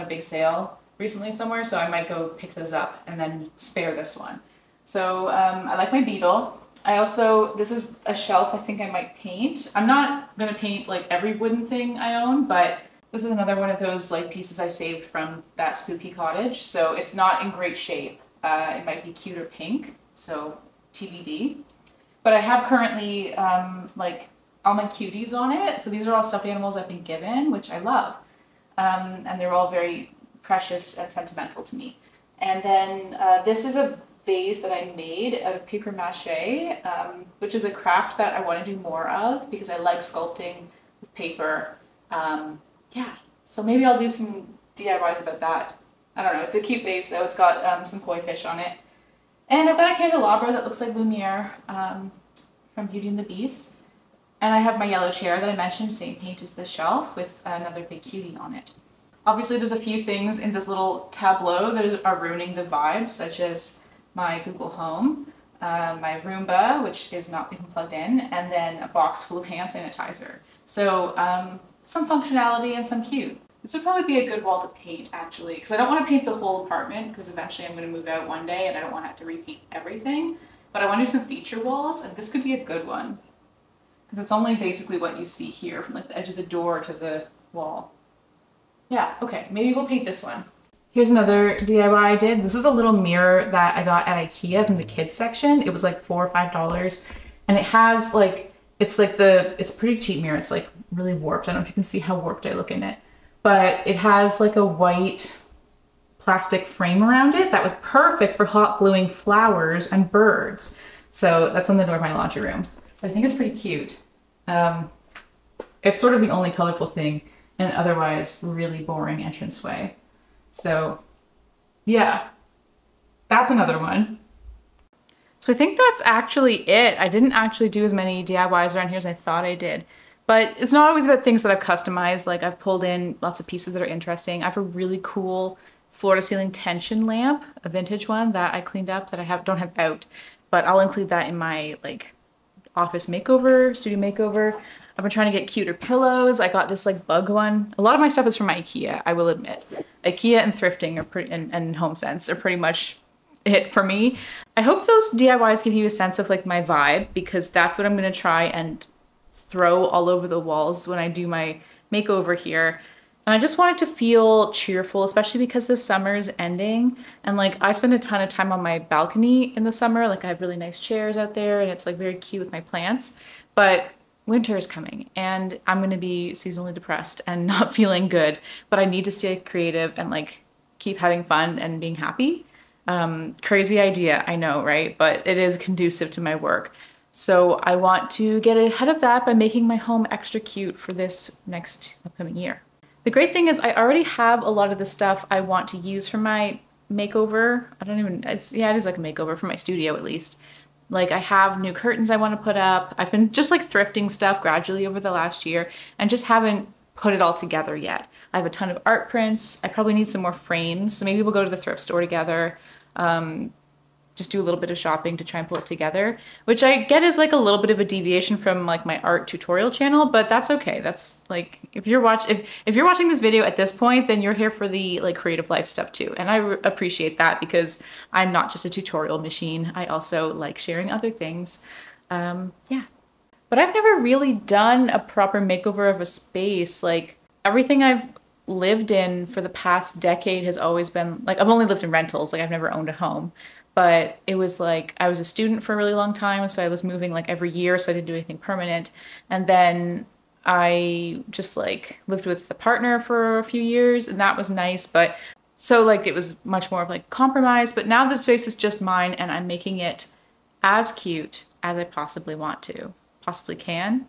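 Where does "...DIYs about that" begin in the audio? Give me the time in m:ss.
0:44.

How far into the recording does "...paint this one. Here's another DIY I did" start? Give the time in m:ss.
1:29.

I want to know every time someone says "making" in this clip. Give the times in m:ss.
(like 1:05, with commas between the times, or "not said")
3:09, 4:19.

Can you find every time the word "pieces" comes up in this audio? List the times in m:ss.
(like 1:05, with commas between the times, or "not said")
0:14, 2:13.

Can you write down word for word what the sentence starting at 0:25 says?
So these are all stuffed animals I've been given, which I love.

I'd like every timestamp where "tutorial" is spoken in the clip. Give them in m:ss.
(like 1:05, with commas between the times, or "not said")
3:39, 3:48.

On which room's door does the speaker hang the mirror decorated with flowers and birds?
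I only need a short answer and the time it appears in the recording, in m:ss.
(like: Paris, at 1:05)
laundry room, at 1:52.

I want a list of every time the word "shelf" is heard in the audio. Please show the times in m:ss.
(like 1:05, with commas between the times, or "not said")
0:08, 0:56.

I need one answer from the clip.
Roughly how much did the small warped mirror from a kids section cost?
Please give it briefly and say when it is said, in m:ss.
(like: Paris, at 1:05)
4 or 5 dollars, at 1:35.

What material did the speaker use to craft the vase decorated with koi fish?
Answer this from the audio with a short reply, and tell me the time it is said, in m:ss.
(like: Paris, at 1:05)
paper mache, at 0:35.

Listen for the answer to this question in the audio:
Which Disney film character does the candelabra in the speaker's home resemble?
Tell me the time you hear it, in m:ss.
0:50.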